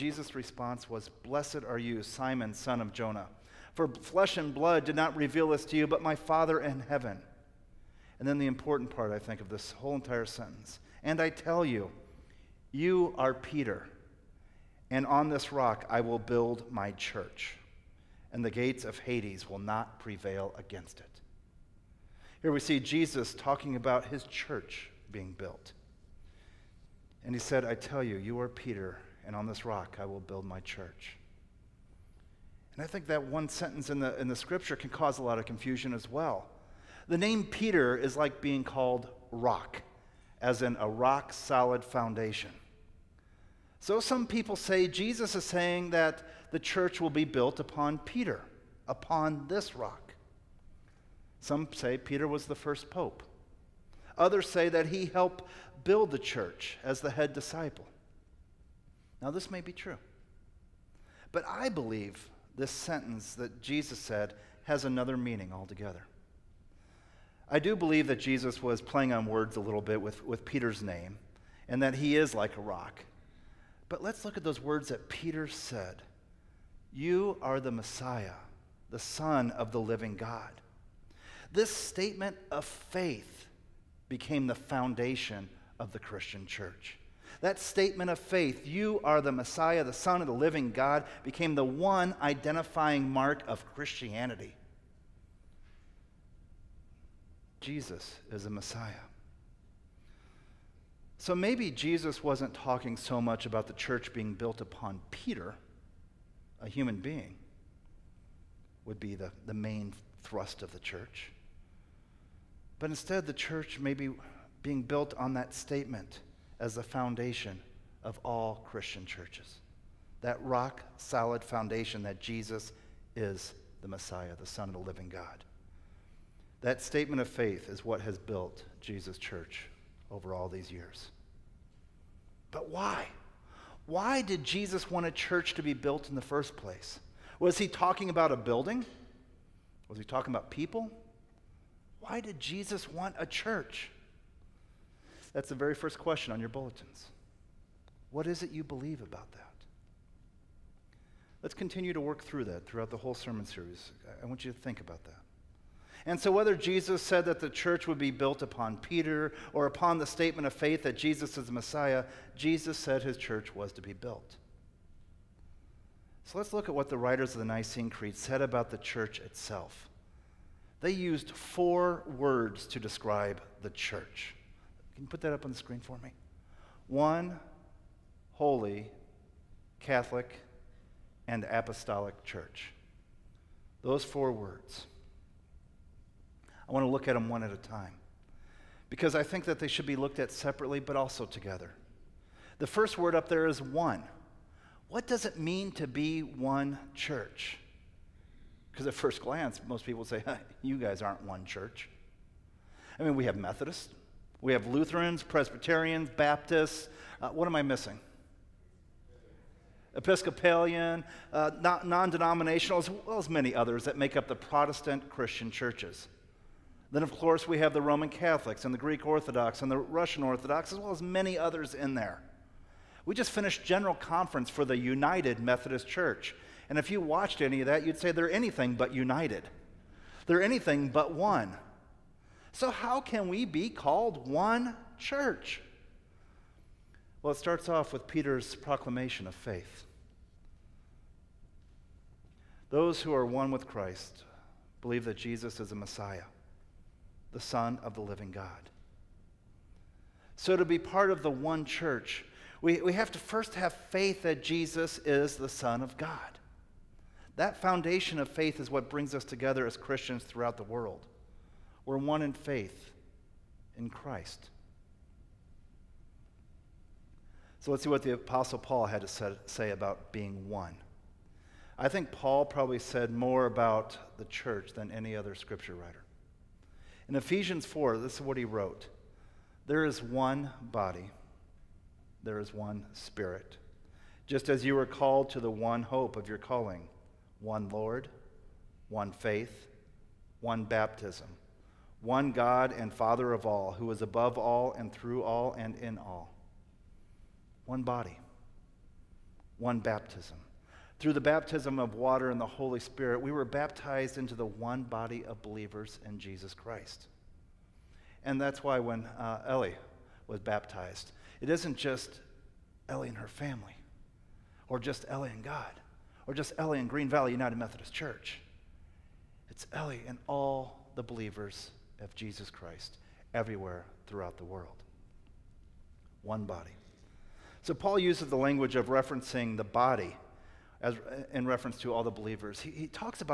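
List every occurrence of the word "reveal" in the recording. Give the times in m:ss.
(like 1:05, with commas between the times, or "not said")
0:05.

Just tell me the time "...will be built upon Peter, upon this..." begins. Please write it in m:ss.
0:46.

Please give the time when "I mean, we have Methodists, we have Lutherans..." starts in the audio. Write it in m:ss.
3:22.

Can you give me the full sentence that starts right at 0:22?
Here we see Jesus talking about his church being built.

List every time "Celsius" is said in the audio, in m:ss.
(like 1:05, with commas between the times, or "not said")
not said.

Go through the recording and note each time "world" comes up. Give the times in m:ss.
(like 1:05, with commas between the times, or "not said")
4:20, 5:24.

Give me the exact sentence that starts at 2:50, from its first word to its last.
They used four words to describe the church can you put that up on the screen for me?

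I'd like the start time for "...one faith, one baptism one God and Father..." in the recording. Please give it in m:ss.
4:48.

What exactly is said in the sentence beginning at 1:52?
But instead, the church may be being built on that statement as the foundation of all Christian churches.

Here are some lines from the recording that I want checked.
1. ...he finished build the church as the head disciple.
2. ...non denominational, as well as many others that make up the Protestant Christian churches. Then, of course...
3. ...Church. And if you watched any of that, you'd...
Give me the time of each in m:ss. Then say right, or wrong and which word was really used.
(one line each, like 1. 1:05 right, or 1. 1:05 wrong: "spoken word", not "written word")
1. 0:54 wrong: "helped", not "finished"
2. 3:31 right
3. 3:45 right.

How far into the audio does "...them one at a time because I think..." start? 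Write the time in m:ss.
3:07.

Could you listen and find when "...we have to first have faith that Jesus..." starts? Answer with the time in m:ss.
4:12.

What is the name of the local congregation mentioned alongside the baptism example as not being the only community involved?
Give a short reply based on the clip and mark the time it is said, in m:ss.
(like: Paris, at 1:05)
Green Valley United Methodist Church, at 5:16.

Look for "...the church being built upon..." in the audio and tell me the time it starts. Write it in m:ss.
1:43.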